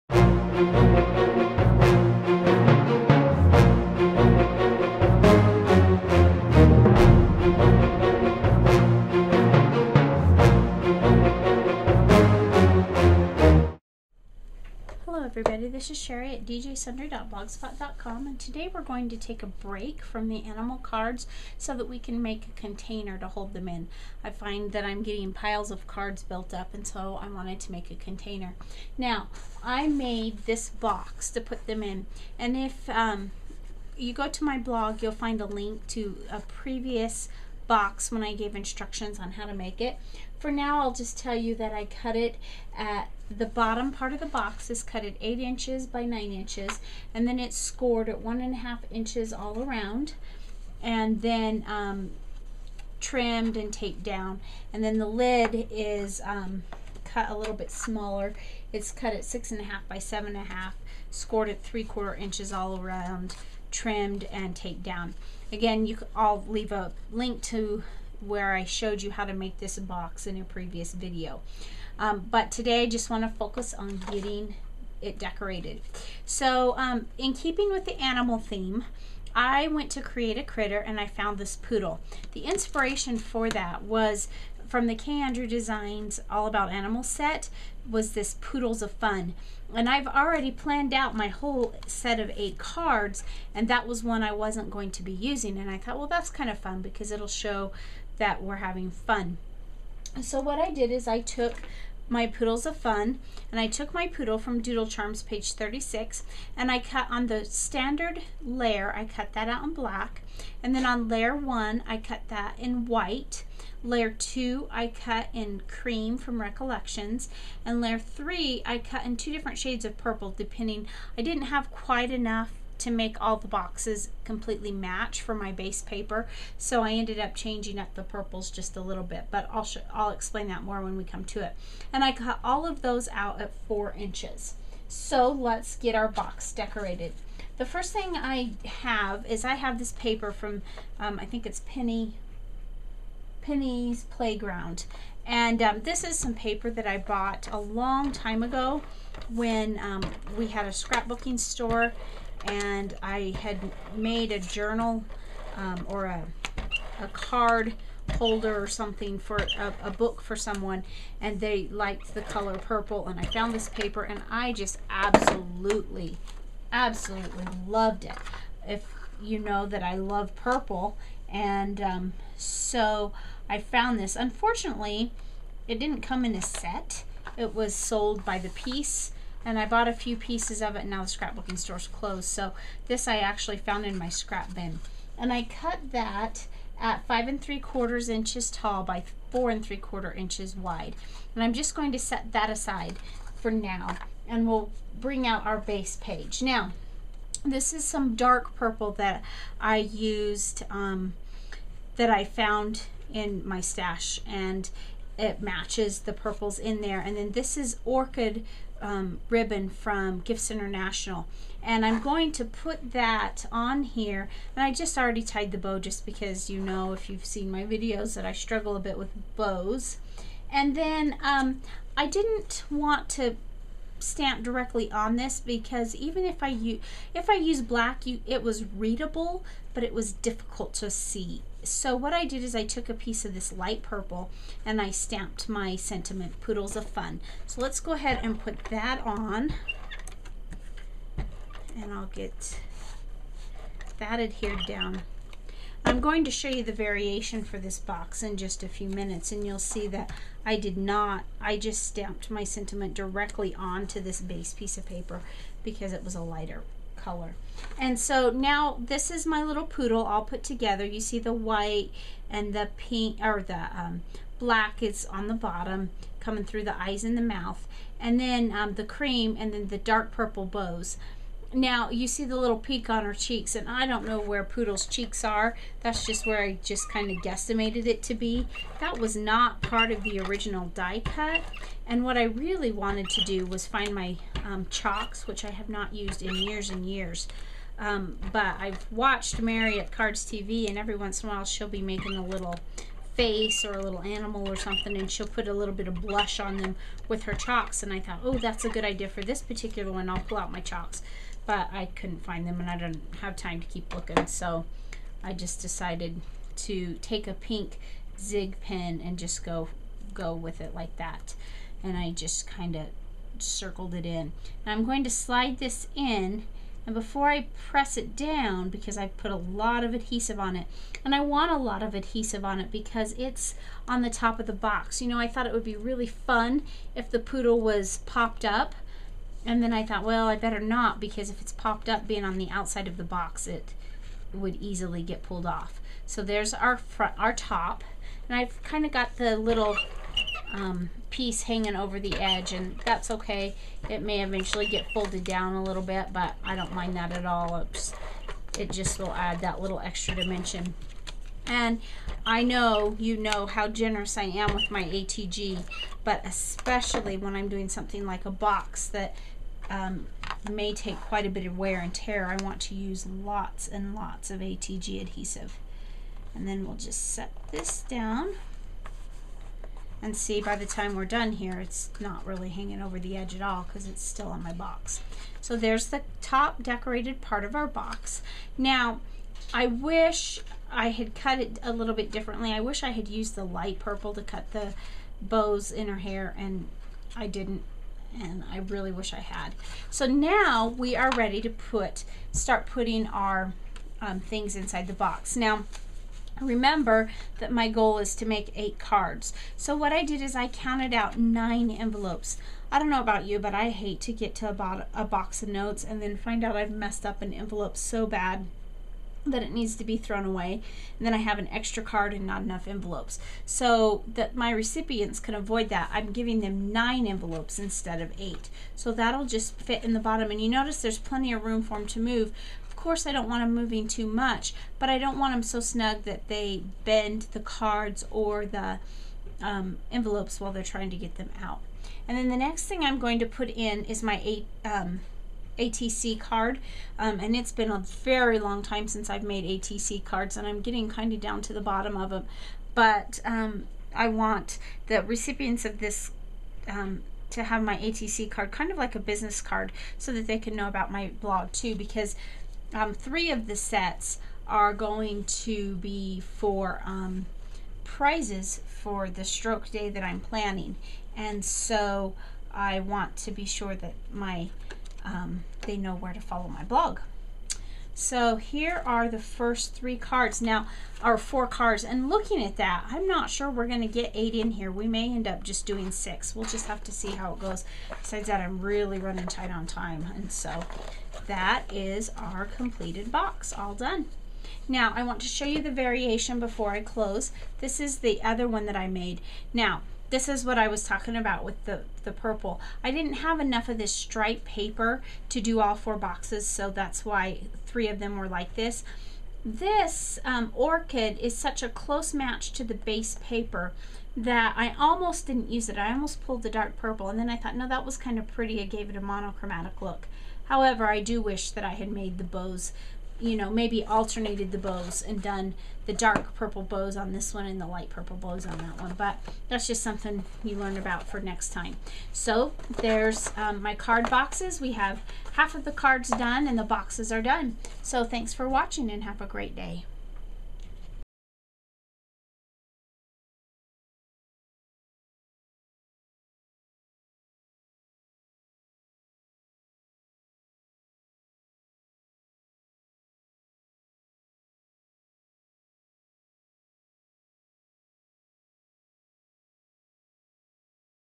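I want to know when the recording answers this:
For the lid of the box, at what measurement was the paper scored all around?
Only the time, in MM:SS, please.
01:01.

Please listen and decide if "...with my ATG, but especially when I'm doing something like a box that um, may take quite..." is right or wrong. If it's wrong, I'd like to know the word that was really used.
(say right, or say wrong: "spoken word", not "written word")
right.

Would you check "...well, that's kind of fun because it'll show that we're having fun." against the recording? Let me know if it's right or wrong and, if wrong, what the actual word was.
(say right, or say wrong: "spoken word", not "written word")
right.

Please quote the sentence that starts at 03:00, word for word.
Now the scrapbooking store's closed, so this I actually found in my scrap bin.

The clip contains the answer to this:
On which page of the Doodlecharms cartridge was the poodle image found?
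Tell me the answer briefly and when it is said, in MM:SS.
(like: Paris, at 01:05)
36, at 01:45.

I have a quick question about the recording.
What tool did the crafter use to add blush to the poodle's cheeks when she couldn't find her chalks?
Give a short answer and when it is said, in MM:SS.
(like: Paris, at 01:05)
pink zig pen, at 05:07.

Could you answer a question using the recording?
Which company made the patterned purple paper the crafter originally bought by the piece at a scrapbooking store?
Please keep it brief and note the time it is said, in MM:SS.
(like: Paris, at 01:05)
Penny's Playground, at 02:23.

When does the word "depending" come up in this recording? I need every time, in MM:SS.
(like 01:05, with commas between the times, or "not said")
02:00.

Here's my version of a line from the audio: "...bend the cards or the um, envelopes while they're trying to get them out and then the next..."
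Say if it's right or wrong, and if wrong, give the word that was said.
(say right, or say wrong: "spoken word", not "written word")
right.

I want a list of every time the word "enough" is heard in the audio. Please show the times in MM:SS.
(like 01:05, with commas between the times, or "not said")
02:02, 06:52, 08:13.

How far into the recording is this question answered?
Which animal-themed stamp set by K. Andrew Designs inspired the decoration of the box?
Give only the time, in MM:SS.
01:26.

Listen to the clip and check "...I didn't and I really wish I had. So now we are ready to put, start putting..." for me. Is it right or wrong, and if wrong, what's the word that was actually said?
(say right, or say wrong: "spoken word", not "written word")
right.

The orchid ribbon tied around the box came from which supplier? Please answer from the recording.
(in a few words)
Gifts International.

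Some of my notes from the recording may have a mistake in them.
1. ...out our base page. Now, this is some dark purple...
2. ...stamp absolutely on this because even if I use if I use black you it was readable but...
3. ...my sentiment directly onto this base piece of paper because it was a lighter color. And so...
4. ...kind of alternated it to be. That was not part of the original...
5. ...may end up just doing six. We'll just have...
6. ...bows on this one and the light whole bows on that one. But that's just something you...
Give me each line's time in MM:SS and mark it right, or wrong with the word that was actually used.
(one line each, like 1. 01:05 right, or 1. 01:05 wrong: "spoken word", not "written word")
1. 03:15 right
2. 03:43 wrong: "directly", not "absolutely"
3. 04:12 right
4. 04:36 wrong: "guesstimated", not "alternated"
5. 07:54 right
6. 08:36 wrong: "purple", not "whole".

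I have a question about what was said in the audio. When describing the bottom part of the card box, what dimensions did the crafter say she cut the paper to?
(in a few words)
8 by 9 inches.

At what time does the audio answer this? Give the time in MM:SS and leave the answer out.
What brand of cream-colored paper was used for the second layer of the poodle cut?
01:56.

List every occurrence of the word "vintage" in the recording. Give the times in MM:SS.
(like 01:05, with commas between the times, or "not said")
not said.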